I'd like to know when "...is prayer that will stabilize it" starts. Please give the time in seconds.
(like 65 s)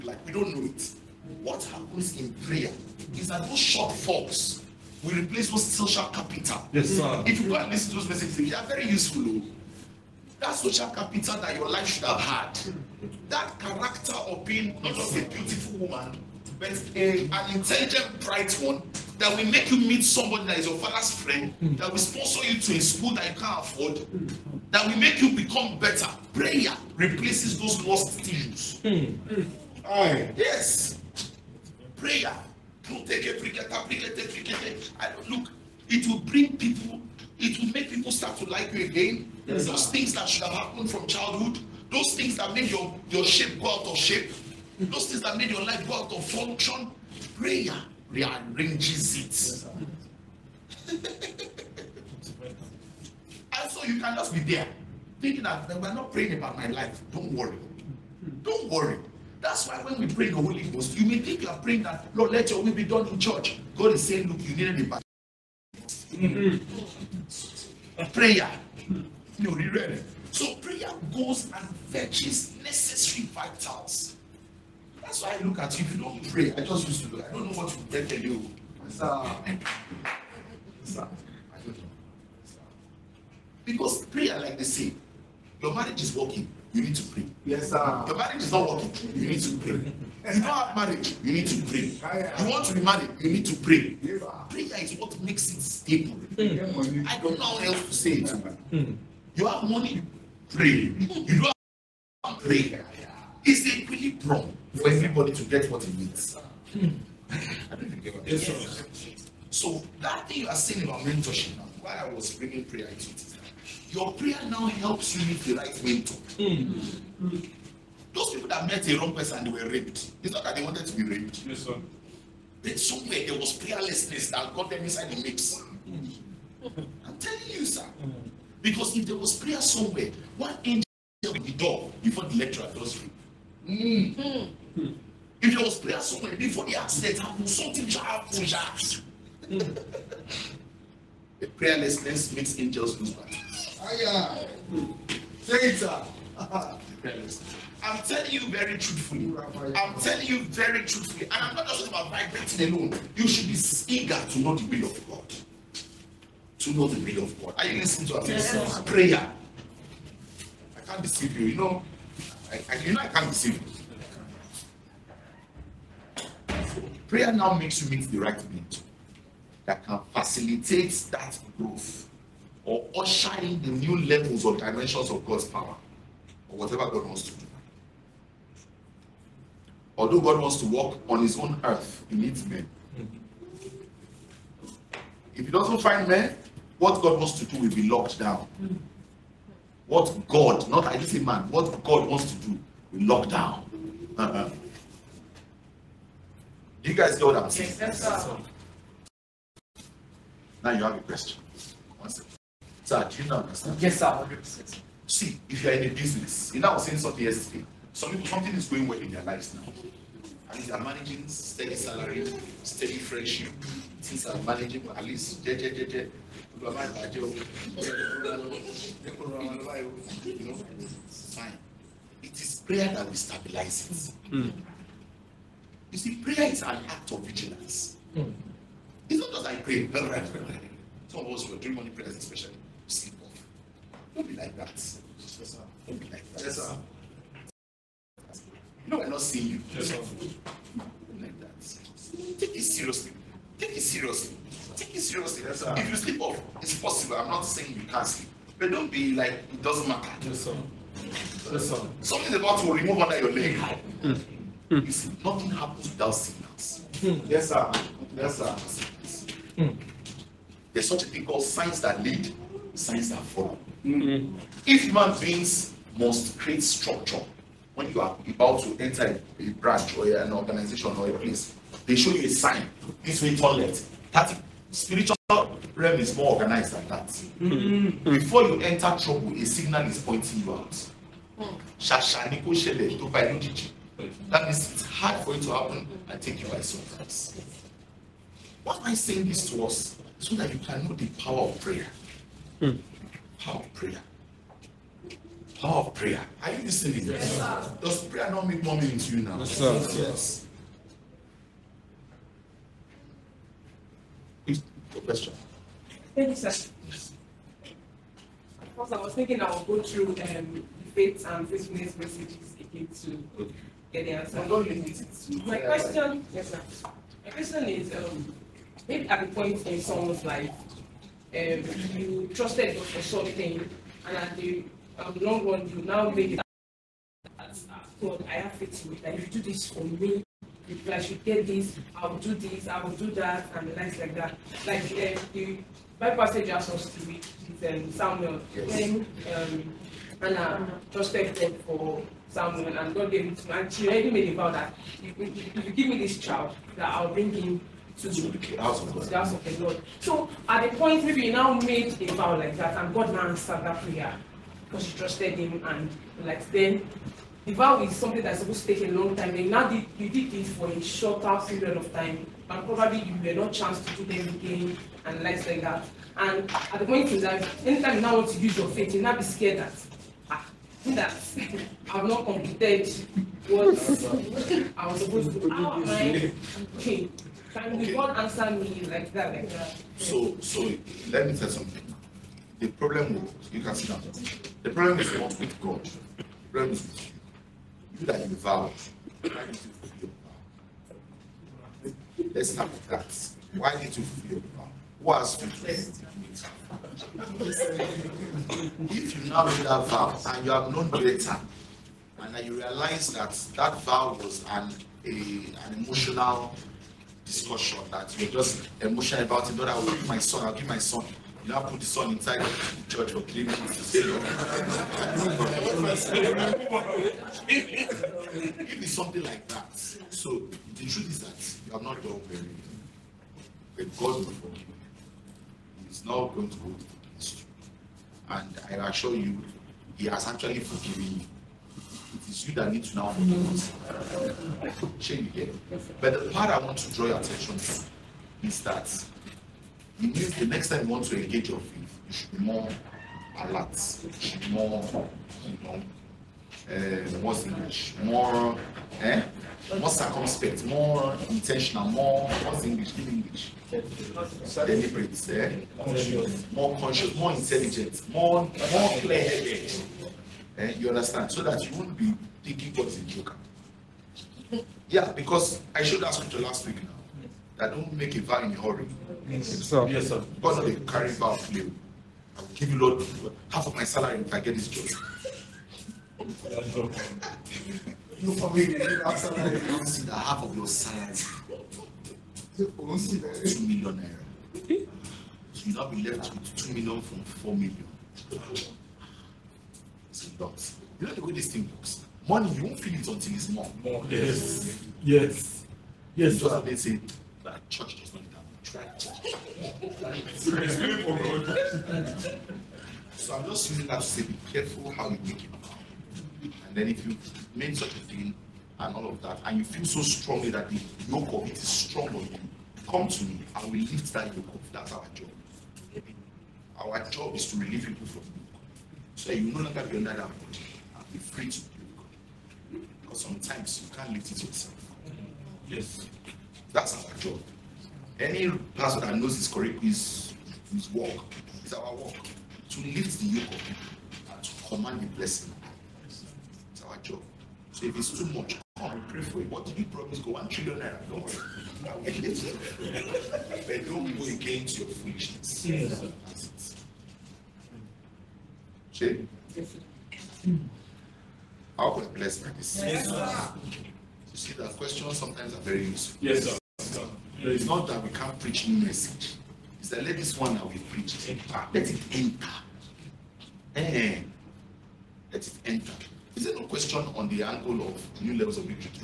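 222 s.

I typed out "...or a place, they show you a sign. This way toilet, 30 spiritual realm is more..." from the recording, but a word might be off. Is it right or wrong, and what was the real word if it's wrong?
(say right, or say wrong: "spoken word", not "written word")
right.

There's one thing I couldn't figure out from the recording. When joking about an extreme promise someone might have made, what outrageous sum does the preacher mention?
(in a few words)
1 trillion naira.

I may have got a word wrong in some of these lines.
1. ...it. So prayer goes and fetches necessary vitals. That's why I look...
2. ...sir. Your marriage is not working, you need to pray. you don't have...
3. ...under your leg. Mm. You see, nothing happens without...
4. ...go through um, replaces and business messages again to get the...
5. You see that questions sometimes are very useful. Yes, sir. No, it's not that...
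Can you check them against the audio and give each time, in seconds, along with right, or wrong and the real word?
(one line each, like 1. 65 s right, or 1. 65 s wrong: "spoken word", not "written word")
1. 69 s right
2. 87 s right
3. 252 s right
4. 309 s wrong: "debates", not "replaces"
5. 553 s right.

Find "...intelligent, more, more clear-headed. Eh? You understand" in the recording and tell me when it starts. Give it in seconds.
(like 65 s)
457 s.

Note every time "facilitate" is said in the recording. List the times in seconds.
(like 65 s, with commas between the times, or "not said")
170 s.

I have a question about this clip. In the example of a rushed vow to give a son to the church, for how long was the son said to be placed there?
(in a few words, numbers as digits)
Three weeks.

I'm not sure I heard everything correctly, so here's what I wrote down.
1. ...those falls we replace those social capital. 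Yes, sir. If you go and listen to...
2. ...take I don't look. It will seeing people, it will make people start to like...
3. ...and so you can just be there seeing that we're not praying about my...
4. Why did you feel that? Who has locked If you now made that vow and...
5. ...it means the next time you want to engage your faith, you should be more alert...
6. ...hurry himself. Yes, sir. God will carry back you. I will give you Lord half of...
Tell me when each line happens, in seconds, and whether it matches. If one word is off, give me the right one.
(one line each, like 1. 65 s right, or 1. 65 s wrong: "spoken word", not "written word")
1. 3 s right
2. 33 s wrong: "bring", not "seeing"
3. 51 s wrong: "thinking", not "seeing"
4. 393 s wrong: "fulfilled", not "locked"
5. 439 s right
6. 468 s right.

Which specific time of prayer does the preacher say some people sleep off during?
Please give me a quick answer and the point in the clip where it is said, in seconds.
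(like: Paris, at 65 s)
Morning prayers, at 231 s.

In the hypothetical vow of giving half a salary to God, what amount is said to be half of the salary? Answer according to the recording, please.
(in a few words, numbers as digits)
2 million naira.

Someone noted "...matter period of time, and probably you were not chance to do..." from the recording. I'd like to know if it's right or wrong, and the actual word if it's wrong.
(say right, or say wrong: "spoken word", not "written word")
wrong: "shorter", not "matter".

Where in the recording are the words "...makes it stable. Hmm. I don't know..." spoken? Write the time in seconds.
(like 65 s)
95 s.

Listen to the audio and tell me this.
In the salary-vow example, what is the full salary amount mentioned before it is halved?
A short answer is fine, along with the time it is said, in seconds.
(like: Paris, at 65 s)
4 million, at 487 s.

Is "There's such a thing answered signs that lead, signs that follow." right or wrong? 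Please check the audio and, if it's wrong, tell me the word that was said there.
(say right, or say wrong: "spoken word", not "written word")
wrong: "called", not "answered".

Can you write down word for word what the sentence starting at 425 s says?
He's not going to go to the place.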